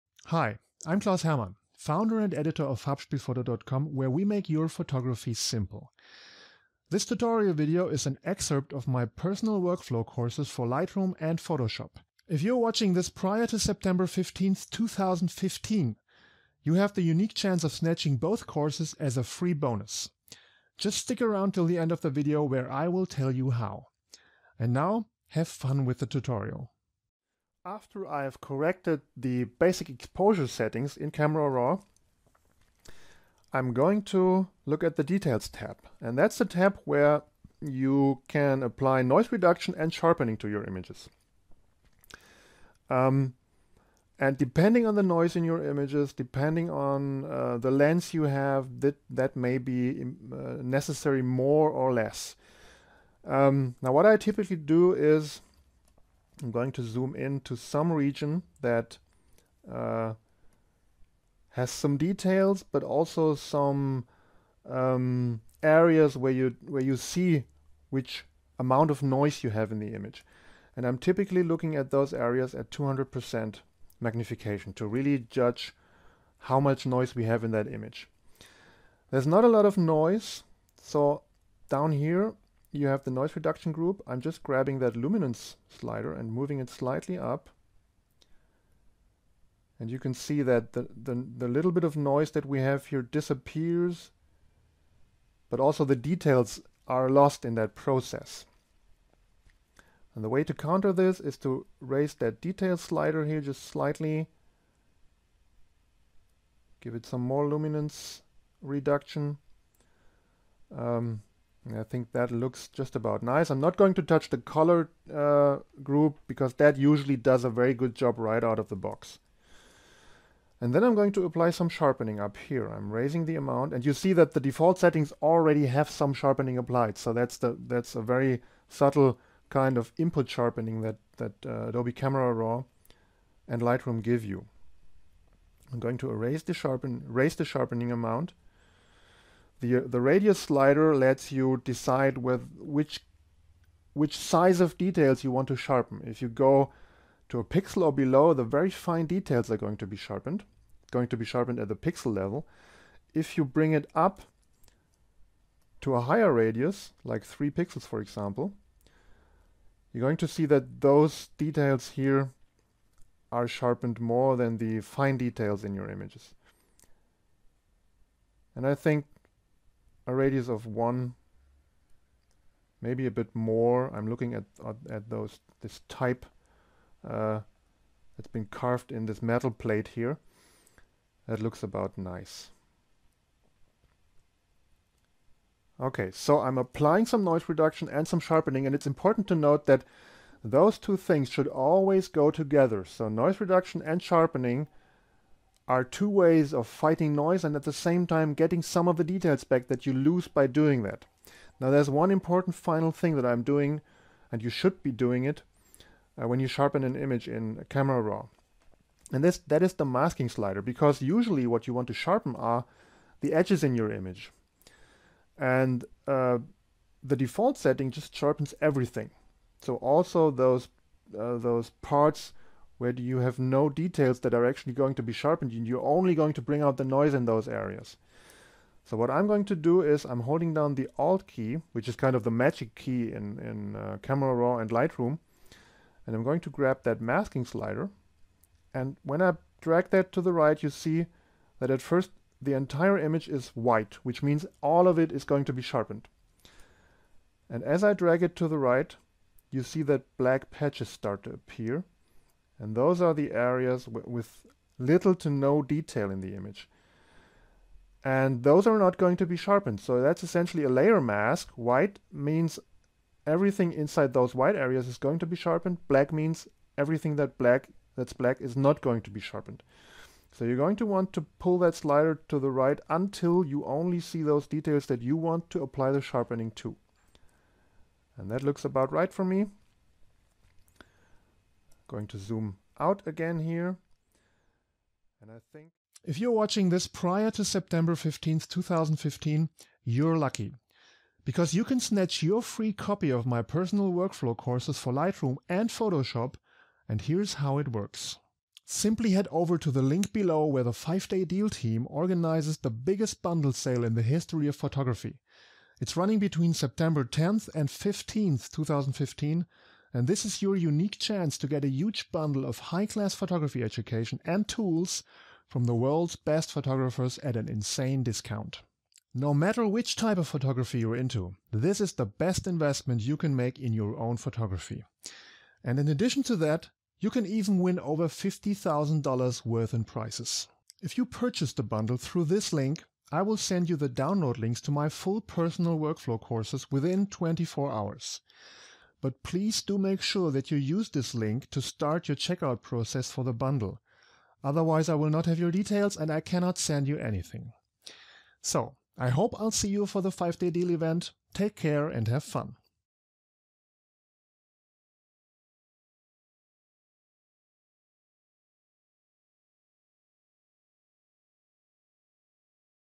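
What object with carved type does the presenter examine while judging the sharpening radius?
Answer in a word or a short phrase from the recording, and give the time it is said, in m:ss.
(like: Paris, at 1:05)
metal plate, at 2:59.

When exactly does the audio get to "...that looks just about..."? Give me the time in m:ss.
1:52.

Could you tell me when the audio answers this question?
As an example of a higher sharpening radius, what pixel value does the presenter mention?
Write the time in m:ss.
2:37.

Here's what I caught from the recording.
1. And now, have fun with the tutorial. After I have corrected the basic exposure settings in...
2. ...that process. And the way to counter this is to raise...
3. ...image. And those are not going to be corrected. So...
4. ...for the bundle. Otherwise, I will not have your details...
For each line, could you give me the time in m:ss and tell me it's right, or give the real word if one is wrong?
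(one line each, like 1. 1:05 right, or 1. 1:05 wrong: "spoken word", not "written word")
1. 0:24 right
2. 1:37 right
3. 4:16 wrong: "sharpened", not "corrected"
4. 5:43 right.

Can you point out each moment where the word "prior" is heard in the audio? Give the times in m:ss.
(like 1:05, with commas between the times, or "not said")
0:13, 4:46.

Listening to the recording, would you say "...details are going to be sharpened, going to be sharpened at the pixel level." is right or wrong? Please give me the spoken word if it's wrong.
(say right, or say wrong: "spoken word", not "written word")
right.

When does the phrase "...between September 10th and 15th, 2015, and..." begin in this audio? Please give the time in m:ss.
5:06.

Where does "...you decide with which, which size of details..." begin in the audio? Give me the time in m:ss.
2:21.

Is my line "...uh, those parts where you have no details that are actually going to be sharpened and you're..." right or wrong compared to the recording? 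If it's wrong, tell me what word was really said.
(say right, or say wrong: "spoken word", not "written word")
right.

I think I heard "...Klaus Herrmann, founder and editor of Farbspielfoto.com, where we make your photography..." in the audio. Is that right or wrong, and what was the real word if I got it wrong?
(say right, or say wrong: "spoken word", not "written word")
right.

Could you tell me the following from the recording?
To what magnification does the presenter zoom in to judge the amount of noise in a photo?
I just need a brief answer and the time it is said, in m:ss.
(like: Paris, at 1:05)
200%, at 1:12.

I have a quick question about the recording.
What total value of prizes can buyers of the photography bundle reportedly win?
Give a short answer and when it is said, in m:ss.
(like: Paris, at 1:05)
over $50,000, at 5:27.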